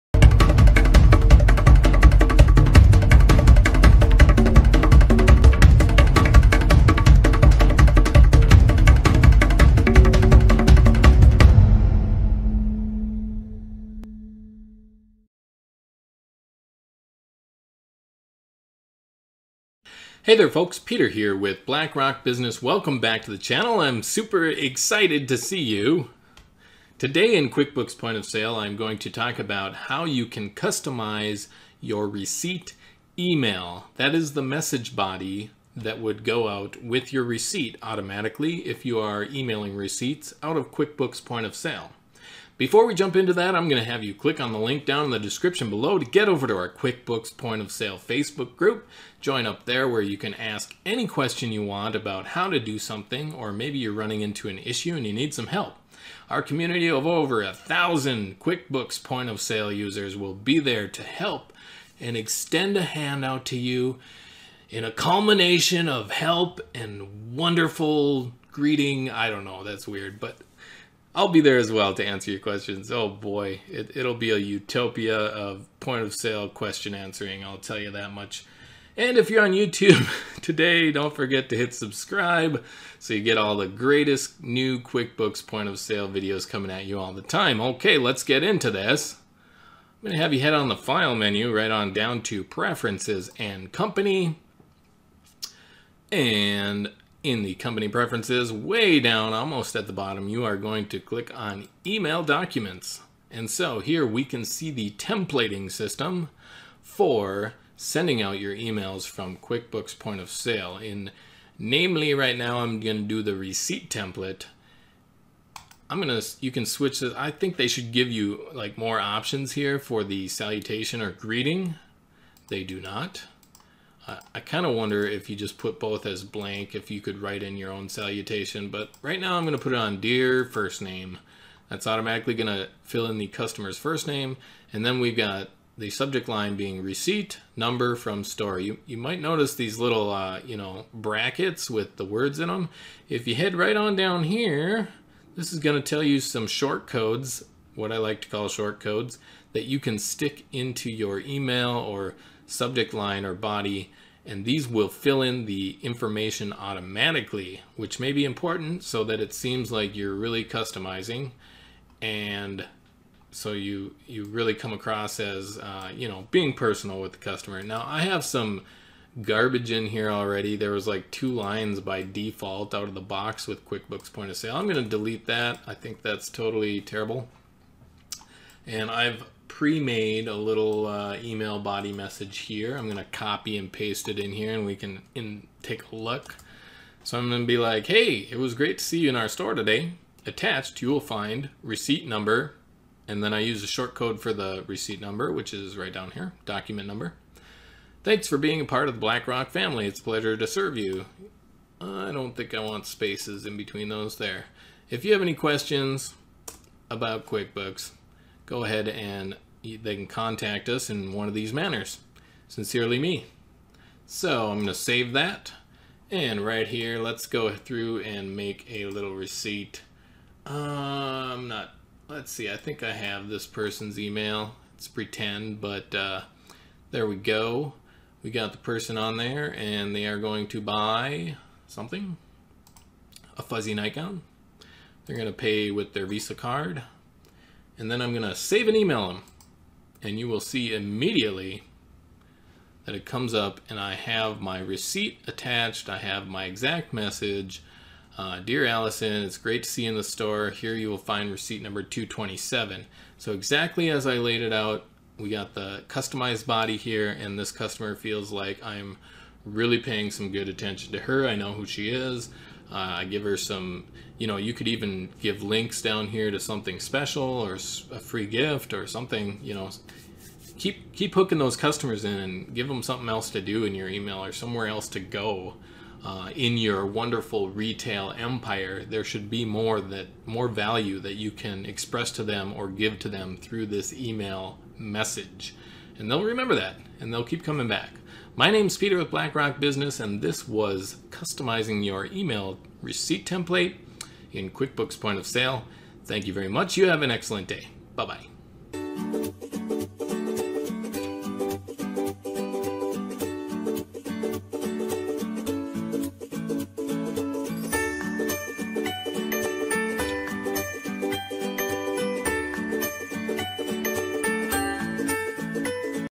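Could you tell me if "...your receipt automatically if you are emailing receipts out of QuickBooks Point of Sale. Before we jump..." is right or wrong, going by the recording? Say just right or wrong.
right.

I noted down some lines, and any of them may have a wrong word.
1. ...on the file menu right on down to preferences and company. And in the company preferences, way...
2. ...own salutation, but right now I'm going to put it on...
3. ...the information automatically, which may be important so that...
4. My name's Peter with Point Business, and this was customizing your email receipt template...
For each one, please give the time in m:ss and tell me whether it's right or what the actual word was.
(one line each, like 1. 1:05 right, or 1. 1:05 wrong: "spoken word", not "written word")
1. 1:30 right
2. 2:07 right
3. 2:35 right
4. 4:48 wrong: "BlackRock", not "Point".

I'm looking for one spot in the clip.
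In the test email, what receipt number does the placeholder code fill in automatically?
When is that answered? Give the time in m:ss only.
4:11.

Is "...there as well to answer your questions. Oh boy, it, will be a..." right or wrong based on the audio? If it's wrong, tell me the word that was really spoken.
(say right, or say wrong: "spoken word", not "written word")
right.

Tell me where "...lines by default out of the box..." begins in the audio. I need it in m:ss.
2:51.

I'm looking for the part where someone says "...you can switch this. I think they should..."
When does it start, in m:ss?
1:56.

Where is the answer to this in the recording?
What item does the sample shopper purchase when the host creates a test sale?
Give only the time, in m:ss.
3:53.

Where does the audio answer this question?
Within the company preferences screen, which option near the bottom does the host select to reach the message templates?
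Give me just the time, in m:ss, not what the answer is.
1:41.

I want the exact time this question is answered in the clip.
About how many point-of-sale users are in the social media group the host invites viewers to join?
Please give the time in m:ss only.
0:57.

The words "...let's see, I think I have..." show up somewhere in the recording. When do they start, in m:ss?
3:42.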